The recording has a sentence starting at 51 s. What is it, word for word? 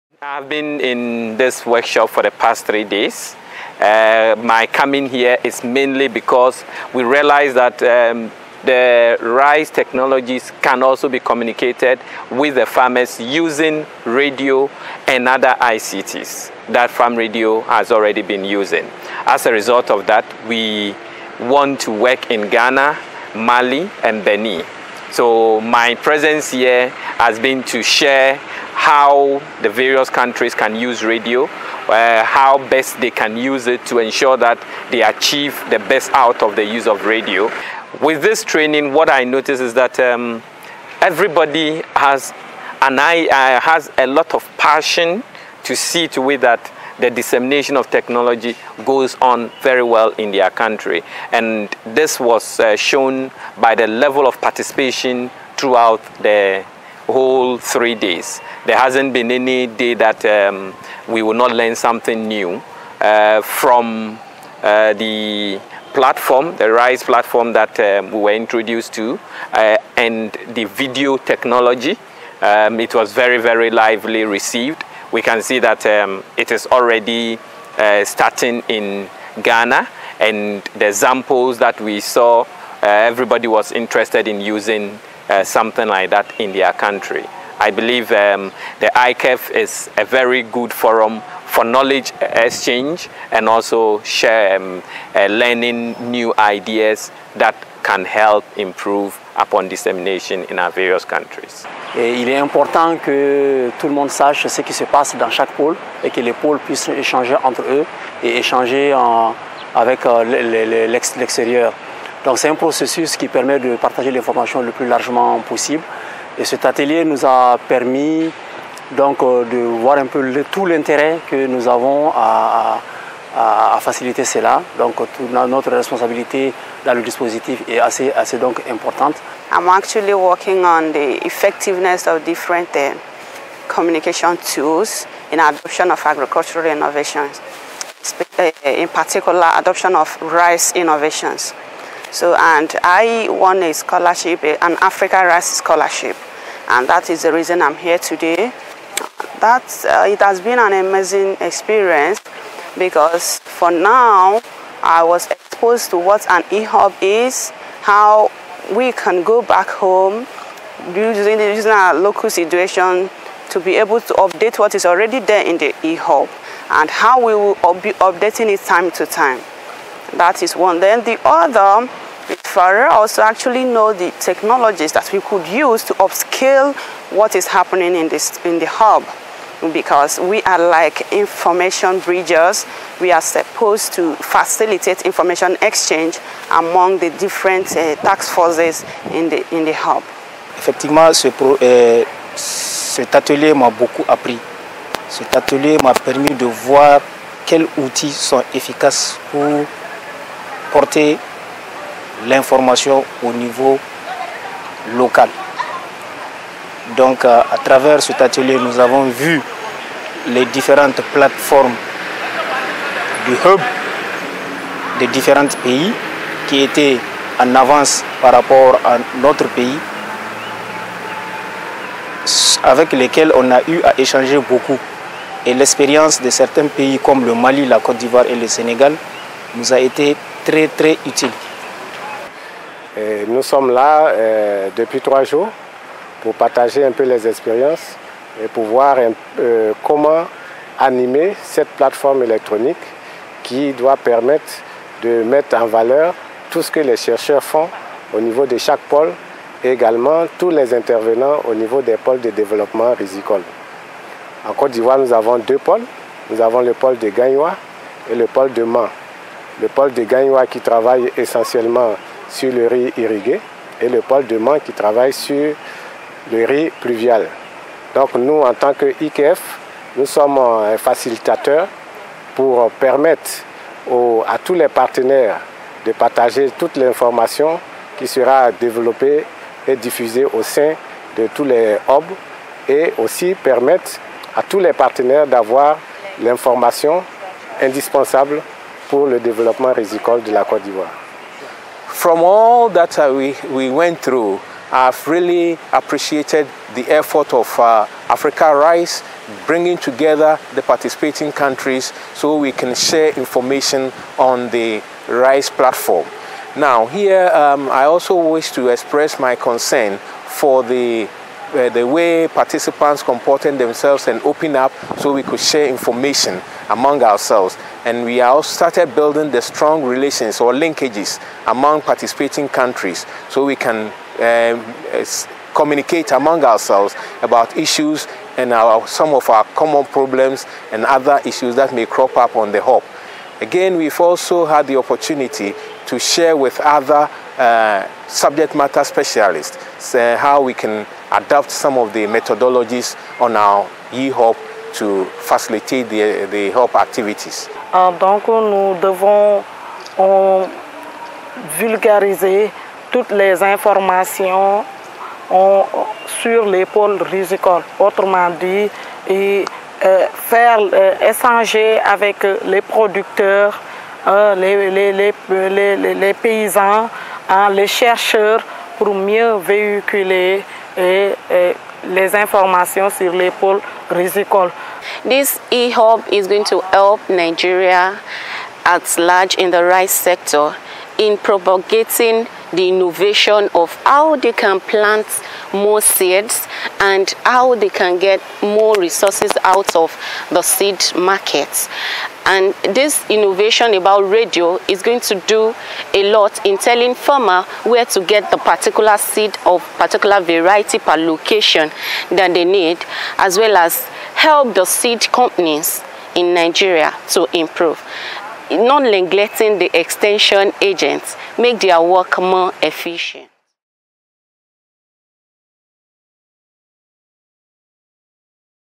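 And this was uh, shown by the level of participation throughout the whole three days.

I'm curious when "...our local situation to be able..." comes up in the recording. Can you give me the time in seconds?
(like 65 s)
161 s.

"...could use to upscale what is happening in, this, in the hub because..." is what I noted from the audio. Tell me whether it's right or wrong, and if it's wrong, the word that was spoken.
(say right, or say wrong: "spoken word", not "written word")
right.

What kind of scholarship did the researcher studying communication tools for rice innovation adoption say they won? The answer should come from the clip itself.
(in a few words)
Africa Rice Scholarship.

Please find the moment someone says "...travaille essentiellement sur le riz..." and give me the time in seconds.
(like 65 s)
260 s.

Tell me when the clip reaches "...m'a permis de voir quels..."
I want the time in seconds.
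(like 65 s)
195 s.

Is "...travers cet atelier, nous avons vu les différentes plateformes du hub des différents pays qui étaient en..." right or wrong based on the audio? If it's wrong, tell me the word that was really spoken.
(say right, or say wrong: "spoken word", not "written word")
right.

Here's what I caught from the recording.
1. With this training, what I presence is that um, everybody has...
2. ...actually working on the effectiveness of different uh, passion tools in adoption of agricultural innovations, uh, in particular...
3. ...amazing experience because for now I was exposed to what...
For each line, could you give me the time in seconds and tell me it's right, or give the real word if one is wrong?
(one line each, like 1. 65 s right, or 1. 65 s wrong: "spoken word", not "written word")
1. 38 s wrong: "notice", not "presence"
2. 129 s wrong: "communication", not "passion"
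3. 150 s right.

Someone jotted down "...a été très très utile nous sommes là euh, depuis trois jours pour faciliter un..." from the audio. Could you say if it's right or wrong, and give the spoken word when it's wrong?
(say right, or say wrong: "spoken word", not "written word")
wrong: "partager", not "faciliter".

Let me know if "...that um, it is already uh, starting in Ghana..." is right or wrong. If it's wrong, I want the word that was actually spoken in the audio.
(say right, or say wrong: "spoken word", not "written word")
right.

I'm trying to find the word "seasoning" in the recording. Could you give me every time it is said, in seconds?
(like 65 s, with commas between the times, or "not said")
not said.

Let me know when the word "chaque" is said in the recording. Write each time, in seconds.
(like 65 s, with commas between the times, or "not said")
105 s, 248 s.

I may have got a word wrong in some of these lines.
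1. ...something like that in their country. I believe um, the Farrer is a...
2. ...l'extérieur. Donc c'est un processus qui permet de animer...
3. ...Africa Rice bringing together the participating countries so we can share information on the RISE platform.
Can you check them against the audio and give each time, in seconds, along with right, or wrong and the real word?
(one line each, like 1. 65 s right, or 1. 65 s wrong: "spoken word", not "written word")
1. 85 s wrong: "IKEF", not "Farrer"
2. 110 s wrong: "partager", not "animer"
3. 298 s right.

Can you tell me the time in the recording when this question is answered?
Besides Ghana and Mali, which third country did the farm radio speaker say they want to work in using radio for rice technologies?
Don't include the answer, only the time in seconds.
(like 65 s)
24 s.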